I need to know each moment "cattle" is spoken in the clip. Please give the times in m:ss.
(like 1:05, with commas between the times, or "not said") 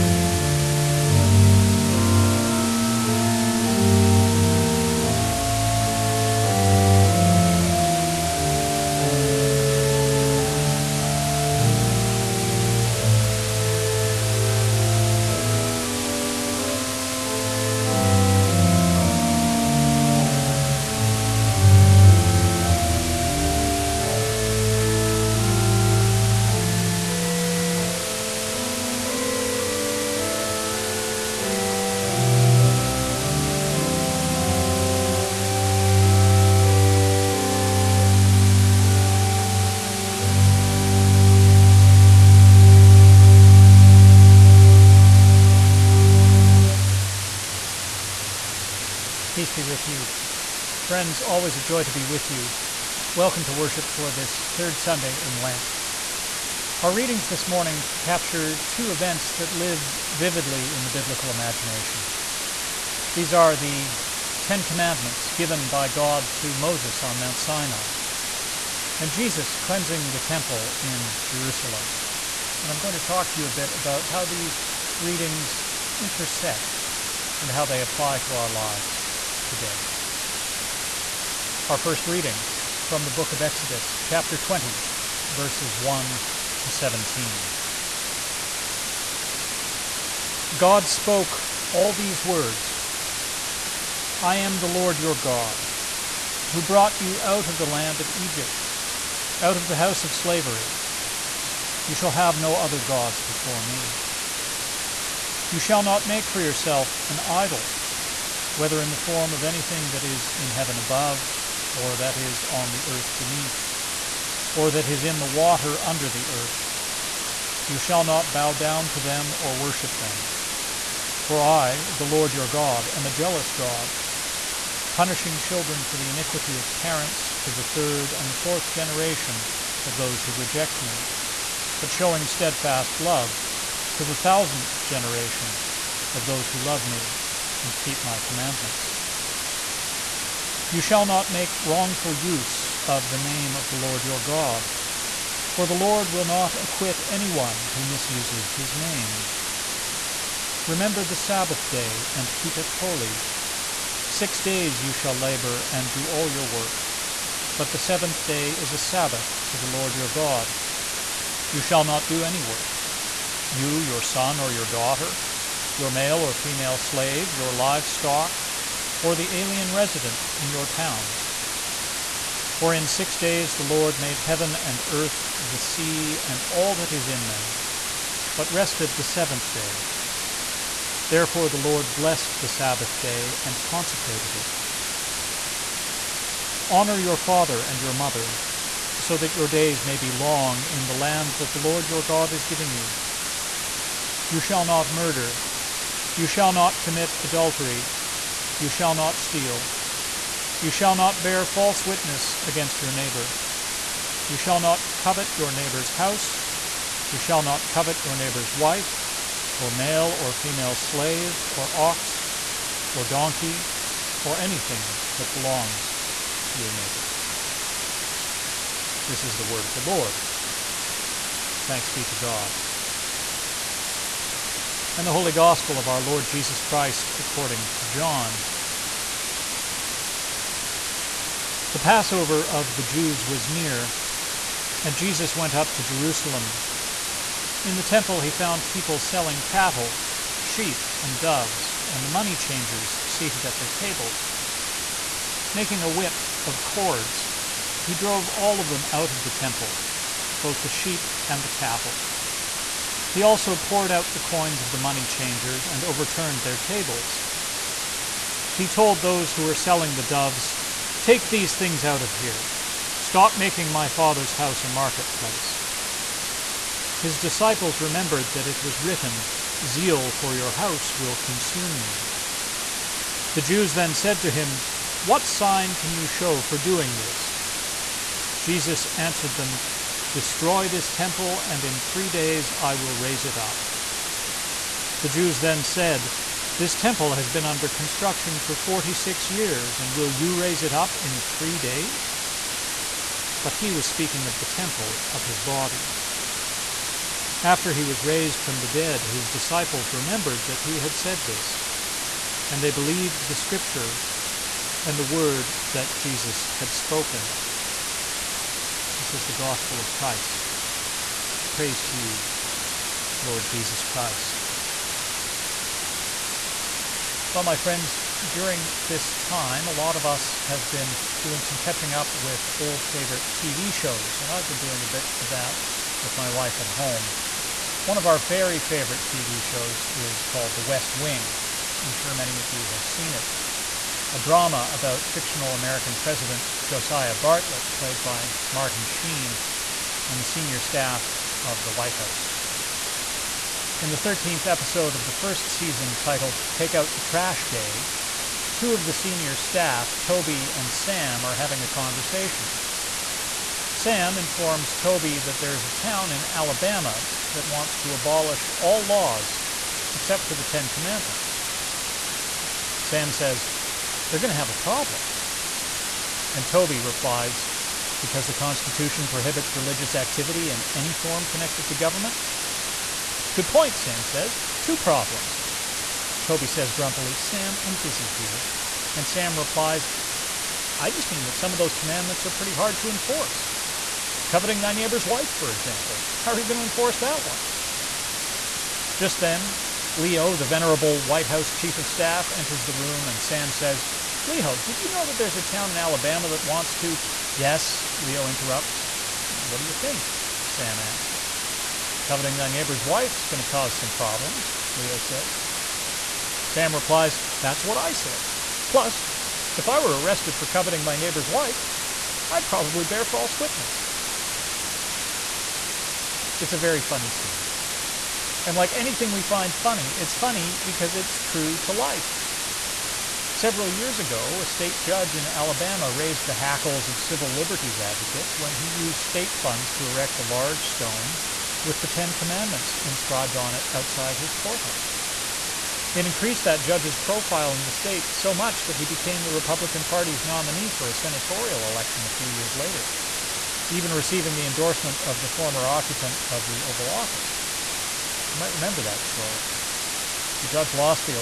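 3:59, 4:11.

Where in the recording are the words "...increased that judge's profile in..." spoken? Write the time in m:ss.
7:16.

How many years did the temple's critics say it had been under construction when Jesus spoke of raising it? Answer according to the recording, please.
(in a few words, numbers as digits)
46.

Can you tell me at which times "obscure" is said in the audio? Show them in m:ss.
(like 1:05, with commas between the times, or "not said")
not said.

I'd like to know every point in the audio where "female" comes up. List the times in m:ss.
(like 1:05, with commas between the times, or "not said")
2:46, 3:30.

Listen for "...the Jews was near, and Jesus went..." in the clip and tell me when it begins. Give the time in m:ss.
3:52.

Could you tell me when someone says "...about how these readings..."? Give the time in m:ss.
1:13.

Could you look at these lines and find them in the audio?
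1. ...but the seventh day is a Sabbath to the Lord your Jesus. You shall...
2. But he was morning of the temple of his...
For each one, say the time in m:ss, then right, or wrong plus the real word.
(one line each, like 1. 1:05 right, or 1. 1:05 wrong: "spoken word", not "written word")
1. 2:37 wrong: "God", not "Jesus"
2. 4:53 wrong: "speaking", not "morning".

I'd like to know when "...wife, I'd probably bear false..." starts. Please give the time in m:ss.
6:51.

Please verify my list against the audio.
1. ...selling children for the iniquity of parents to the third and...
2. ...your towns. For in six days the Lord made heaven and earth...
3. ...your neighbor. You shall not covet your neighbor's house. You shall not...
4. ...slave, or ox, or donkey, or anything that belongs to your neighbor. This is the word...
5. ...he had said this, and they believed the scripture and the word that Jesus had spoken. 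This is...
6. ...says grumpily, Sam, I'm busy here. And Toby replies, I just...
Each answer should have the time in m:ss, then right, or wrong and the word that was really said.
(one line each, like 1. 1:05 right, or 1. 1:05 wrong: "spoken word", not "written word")
1. 2:04 wrong: "punishing", not "selling"
2. 2:50 right
3. 3:22 right
4. 3:30 right
5. 5:00 right
6. 6:16 wrong: "Sam", not "Toby".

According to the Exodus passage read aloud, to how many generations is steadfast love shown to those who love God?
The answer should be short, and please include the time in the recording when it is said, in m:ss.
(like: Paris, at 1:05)
the thousandth, at 2:14.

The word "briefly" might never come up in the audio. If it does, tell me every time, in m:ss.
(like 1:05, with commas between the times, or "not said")
not said.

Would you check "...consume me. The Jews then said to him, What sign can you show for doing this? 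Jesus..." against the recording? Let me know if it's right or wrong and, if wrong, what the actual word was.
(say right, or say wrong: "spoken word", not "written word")
right.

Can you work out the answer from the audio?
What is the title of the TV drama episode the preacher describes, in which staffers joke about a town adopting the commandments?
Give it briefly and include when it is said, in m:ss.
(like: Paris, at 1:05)
Take Out the Trash Day, at 5:46.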